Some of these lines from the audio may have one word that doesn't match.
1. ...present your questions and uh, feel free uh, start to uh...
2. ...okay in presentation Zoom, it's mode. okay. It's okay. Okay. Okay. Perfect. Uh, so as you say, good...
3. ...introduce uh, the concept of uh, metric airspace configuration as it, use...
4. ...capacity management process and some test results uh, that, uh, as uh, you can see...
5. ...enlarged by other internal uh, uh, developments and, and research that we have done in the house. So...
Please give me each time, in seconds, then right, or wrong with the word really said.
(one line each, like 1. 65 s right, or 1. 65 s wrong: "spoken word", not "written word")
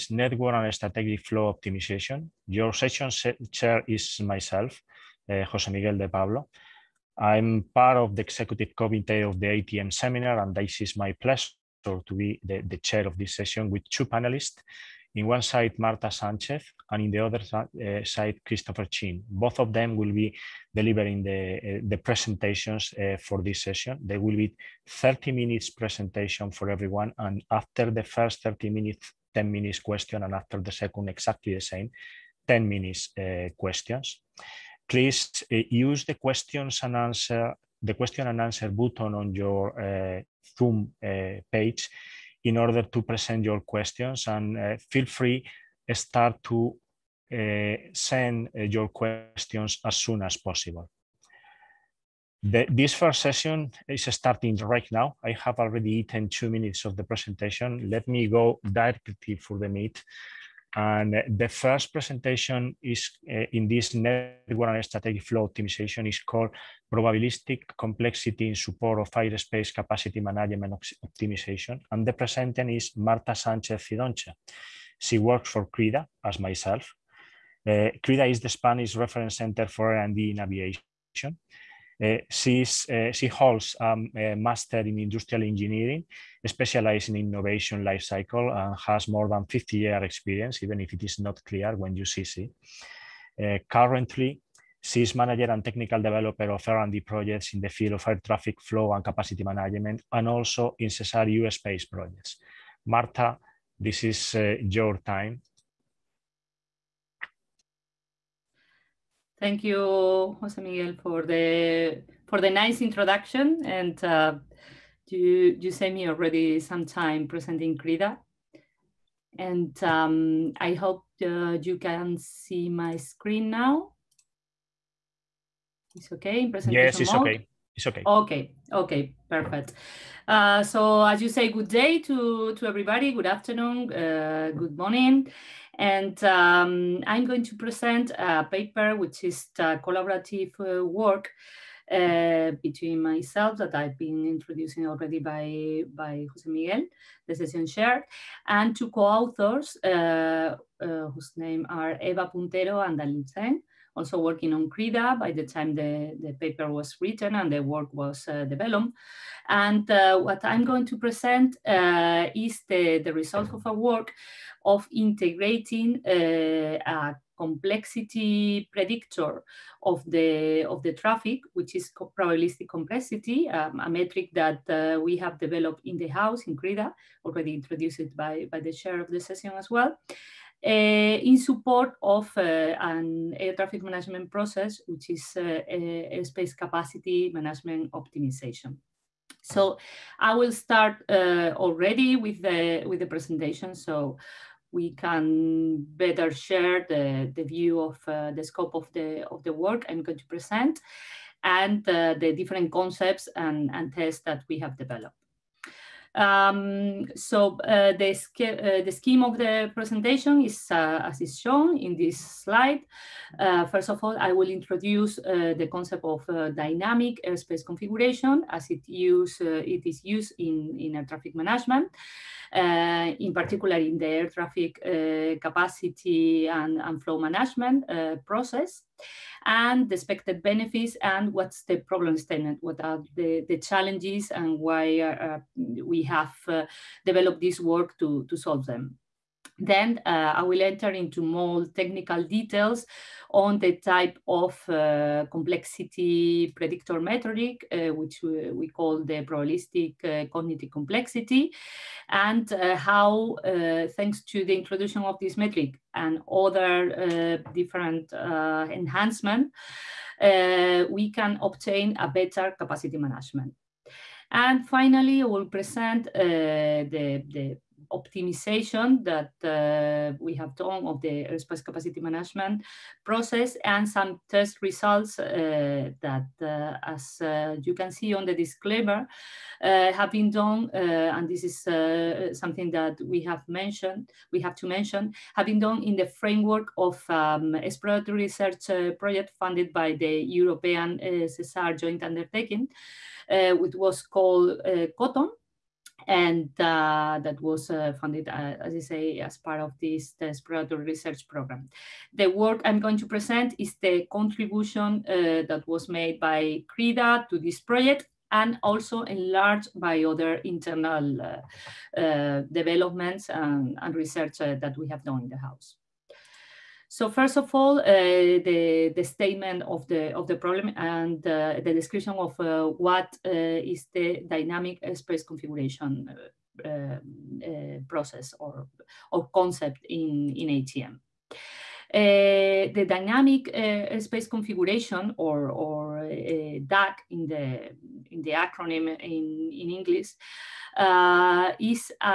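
1. 43 s right
2. 126 s wrong: "Yes", not "Zoom"
3. 214 s wrong: "dynamic", not "metric"
4. 271 s right
5. 309 s right.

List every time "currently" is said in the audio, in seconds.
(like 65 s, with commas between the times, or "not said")
93 s.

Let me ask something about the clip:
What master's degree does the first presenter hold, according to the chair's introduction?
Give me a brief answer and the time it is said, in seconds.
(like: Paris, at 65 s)
industrial engineering, at 84 s.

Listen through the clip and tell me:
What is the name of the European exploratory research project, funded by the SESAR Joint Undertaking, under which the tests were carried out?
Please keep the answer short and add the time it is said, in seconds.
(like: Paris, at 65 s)
COTTON, at 294 s.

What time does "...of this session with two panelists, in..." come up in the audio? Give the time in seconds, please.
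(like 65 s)
13 s.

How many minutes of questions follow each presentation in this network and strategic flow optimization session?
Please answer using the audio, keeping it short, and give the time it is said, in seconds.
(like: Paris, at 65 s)
10, at 29 s.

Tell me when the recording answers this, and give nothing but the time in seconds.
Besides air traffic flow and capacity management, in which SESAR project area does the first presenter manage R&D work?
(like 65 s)
101 s.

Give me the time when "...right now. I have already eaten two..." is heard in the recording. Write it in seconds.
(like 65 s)
54 s.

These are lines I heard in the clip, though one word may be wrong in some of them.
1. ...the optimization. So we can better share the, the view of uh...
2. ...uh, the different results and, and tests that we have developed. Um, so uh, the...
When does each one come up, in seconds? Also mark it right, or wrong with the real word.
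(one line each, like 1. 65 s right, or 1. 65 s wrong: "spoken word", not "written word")
1. 193 s wrong: "presentation", not "optimization"
2. 201 s wrong: "concepts", not "results".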